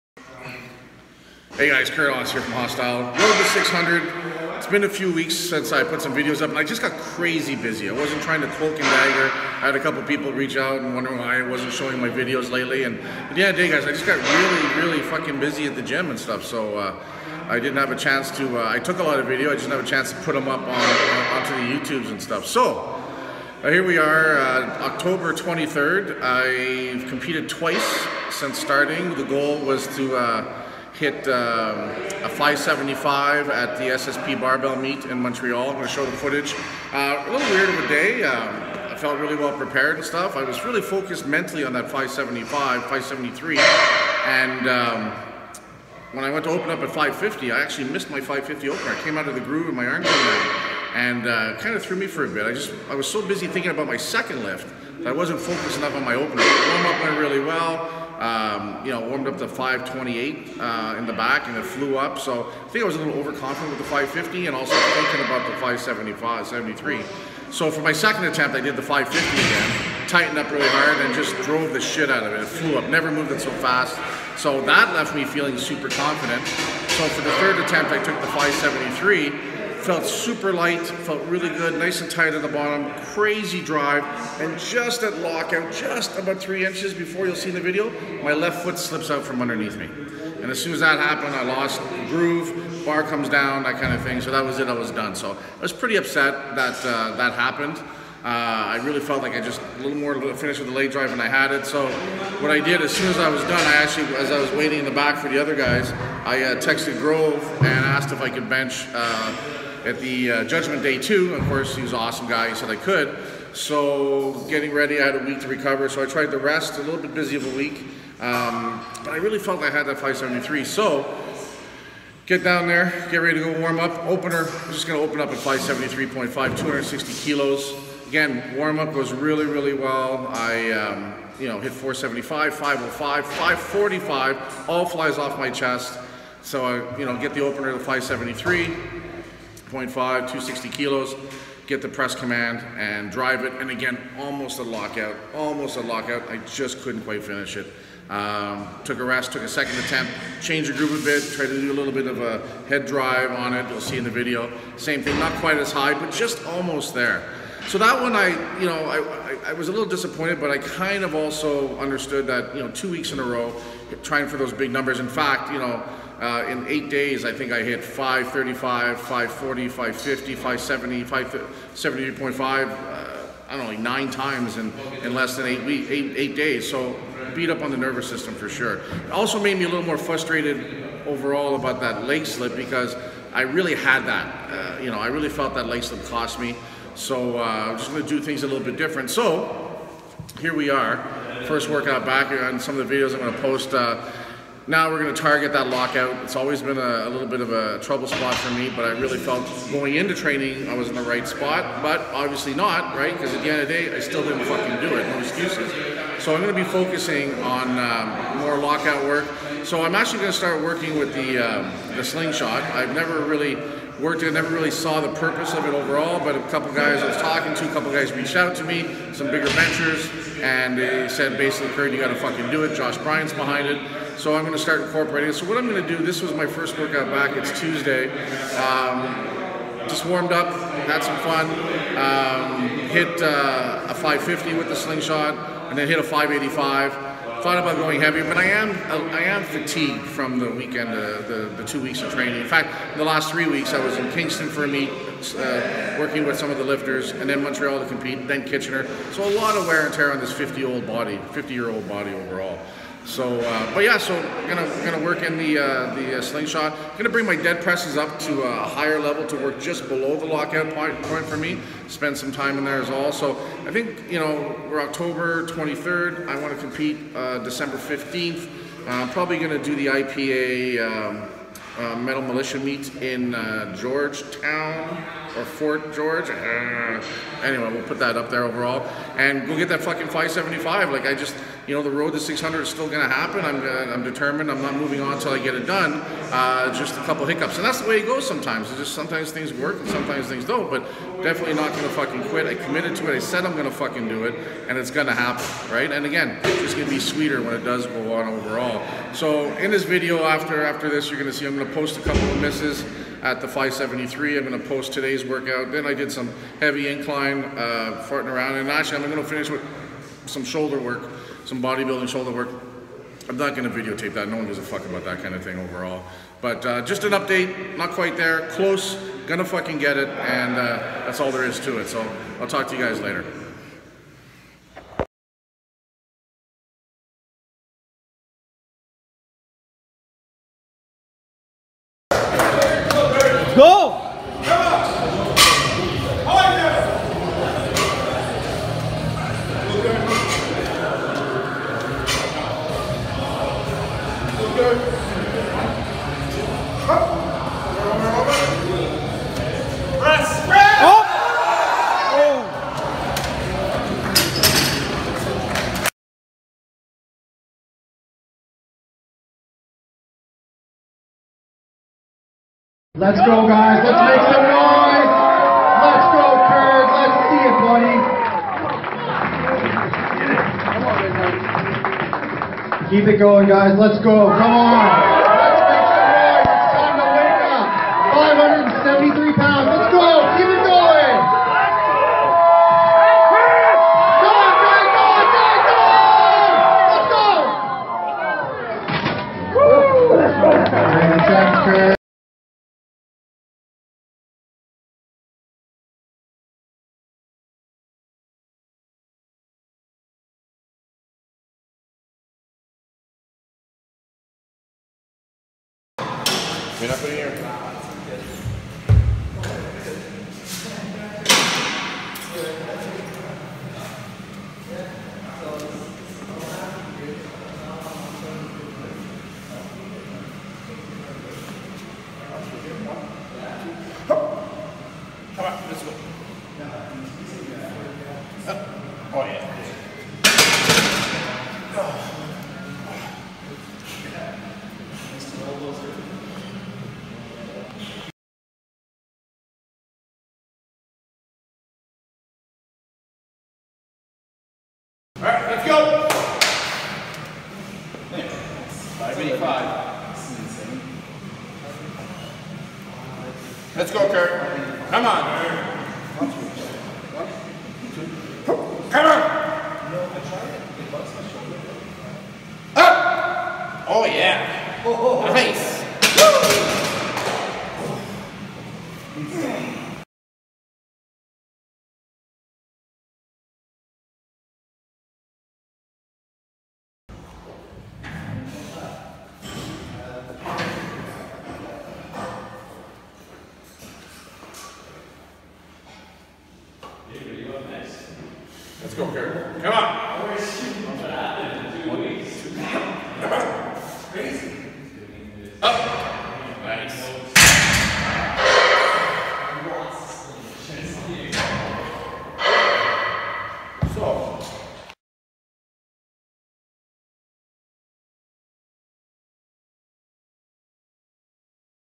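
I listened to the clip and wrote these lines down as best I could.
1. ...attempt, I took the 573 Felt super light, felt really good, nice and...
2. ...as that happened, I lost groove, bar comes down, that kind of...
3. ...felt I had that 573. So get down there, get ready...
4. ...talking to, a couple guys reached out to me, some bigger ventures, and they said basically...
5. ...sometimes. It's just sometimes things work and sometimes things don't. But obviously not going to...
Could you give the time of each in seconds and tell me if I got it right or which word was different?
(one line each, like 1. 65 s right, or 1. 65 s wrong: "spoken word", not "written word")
1. 77 s right
2. 90 s right
3. 119 s right
4. 217 s right
5. 288 s wrong: "definitely", not "obviously".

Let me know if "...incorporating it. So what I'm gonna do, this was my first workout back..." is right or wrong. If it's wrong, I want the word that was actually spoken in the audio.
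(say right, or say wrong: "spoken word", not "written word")
right.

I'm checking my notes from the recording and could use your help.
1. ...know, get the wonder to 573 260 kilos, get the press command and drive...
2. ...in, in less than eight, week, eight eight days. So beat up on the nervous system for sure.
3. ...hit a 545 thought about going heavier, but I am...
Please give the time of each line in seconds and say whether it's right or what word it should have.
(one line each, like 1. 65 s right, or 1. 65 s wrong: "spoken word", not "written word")
1. 137 s wrong: "opener", not "wonder"
2. 174 s right
3. 235 s wrong: "585", not "545".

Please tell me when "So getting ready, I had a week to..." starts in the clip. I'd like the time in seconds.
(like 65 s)
113 s.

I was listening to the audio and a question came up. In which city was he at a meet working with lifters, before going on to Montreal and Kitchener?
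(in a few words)
Kingston.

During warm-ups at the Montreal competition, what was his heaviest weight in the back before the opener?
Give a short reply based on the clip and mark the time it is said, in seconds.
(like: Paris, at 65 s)
528, at 59 s.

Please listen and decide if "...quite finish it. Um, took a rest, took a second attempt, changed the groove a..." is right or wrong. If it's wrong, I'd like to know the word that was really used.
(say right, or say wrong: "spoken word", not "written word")
right.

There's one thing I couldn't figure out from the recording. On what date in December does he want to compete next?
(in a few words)
December 15.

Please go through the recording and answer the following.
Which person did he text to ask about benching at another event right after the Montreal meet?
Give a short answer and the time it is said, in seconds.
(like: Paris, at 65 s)
Grove, at 106 s.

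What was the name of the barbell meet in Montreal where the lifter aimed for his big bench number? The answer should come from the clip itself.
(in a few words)
SSP.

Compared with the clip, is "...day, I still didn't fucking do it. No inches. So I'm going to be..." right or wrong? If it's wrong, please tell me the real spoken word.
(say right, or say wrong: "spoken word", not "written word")
wrong: "excuses", not "inches".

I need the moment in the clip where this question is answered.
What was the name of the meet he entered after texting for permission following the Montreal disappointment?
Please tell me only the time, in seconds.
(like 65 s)
110 s.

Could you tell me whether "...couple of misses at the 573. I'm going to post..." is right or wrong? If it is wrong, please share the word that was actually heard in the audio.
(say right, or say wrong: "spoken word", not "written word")
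right.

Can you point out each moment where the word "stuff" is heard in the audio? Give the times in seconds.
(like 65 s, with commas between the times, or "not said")
16 s, 22 s, 40 s.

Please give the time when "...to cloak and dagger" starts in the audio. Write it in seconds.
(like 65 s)
8 s.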